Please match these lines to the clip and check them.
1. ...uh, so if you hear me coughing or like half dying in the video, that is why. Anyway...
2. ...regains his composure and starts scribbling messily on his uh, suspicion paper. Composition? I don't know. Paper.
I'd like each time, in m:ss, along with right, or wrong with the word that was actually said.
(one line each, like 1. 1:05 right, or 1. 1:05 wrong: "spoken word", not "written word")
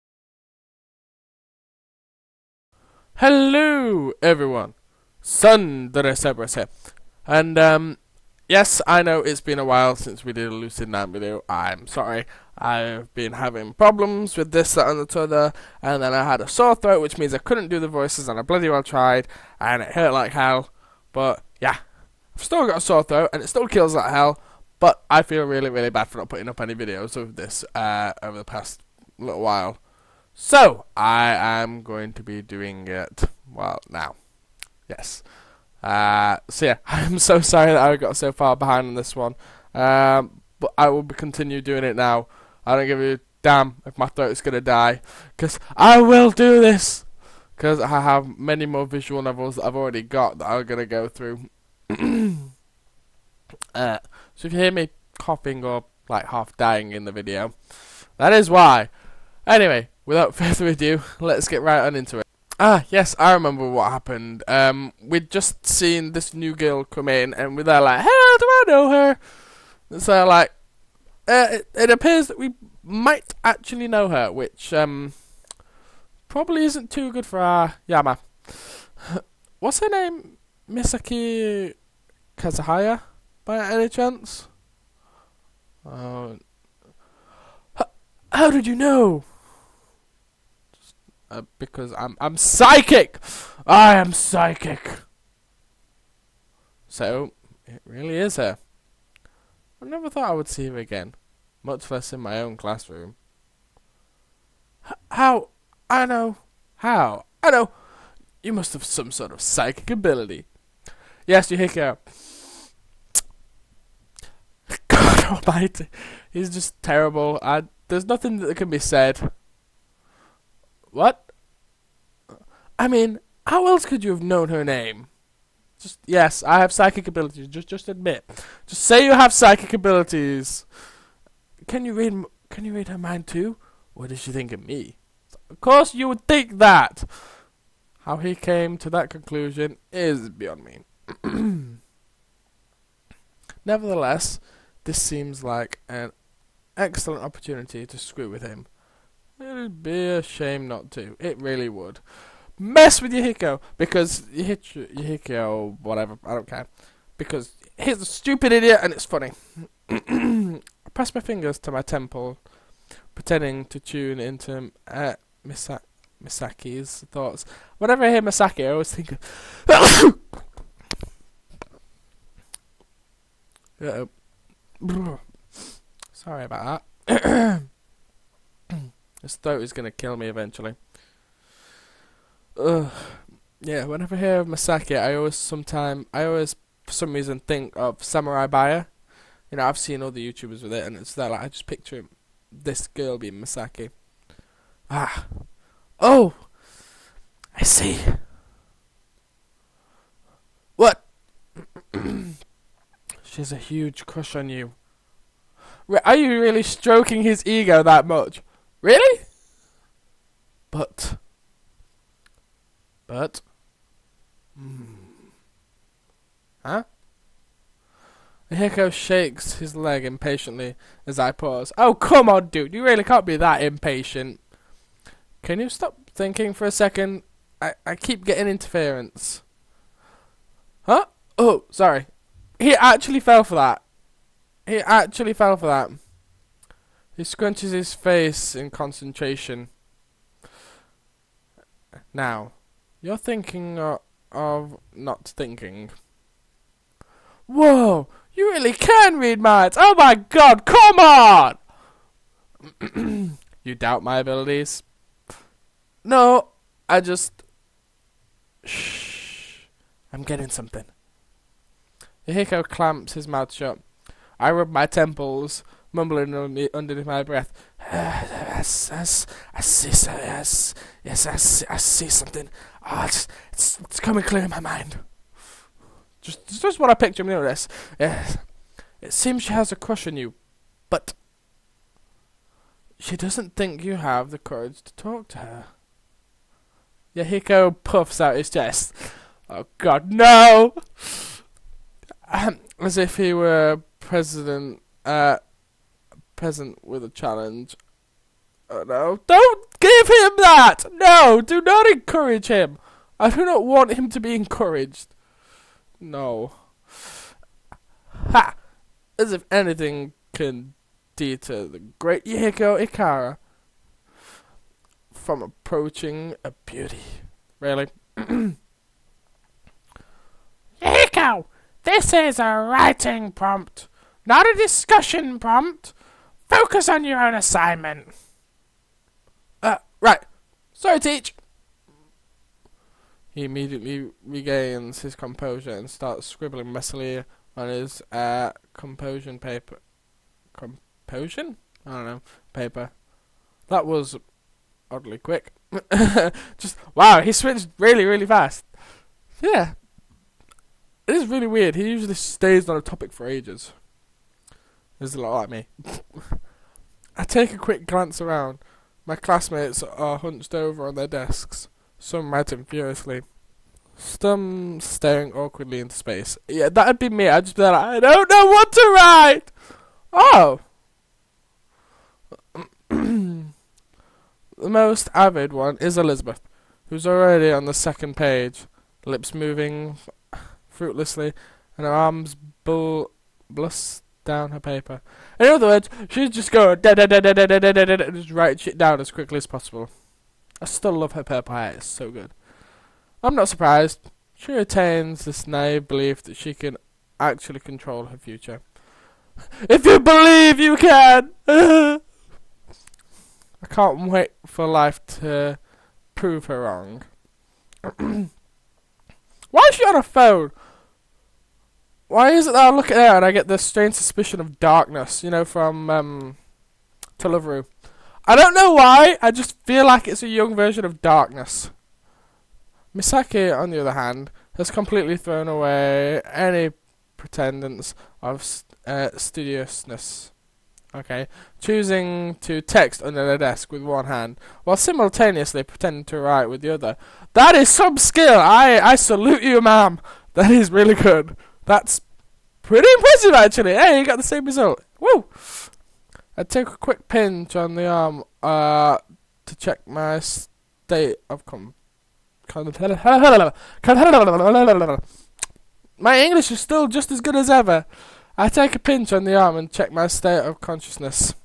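1. 0:51 right
2. 5:34 wrong: "composition", not "suspicion".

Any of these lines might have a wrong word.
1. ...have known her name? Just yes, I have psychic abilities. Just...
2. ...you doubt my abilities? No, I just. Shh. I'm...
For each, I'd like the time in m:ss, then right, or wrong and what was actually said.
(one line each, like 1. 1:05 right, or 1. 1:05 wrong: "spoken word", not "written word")
1. 2:04 right
2. 4:13 right.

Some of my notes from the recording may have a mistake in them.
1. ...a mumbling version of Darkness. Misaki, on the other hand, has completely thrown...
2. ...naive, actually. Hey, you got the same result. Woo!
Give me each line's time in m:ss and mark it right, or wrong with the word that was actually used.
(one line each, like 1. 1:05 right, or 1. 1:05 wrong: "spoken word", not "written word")
1. 7:00 wrong: "young", not "mumbling"
2. 7:22 wrong: "impressive", not "naive".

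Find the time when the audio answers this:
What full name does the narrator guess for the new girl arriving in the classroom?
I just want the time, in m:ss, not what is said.
1:20.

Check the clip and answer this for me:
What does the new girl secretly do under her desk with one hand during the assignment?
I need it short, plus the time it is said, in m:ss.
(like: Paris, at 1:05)
Text, at 7:12.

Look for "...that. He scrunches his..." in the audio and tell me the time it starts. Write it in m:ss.
3:55.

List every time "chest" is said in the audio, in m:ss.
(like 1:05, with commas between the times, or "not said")
4:48.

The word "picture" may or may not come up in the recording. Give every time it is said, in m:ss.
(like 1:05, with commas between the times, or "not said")
3:11, 4:36.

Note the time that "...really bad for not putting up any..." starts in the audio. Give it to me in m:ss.
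0:25.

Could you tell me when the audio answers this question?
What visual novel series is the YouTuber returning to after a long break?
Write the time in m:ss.
0:10.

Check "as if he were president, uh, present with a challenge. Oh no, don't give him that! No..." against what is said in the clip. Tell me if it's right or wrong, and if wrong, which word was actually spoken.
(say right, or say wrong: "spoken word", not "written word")
right.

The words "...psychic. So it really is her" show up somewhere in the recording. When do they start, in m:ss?
1:34.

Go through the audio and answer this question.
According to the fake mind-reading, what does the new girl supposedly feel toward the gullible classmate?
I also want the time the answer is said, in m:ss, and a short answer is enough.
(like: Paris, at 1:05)
A huge crush, at 3:23.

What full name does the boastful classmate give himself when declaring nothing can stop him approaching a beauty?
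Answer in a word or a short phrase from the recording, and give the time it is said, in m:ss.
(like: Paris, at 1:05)
Yehiko Ikara, at 5:12.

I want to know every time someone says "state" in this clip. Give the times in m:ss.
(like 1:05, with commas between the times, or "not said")
7:30, 7:40.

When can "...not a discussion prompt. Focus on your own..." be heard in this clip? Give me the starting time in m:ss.
5:24.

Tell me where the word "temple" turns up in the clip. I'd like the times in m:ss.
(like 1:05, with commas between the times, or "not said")
2:41, 4:24.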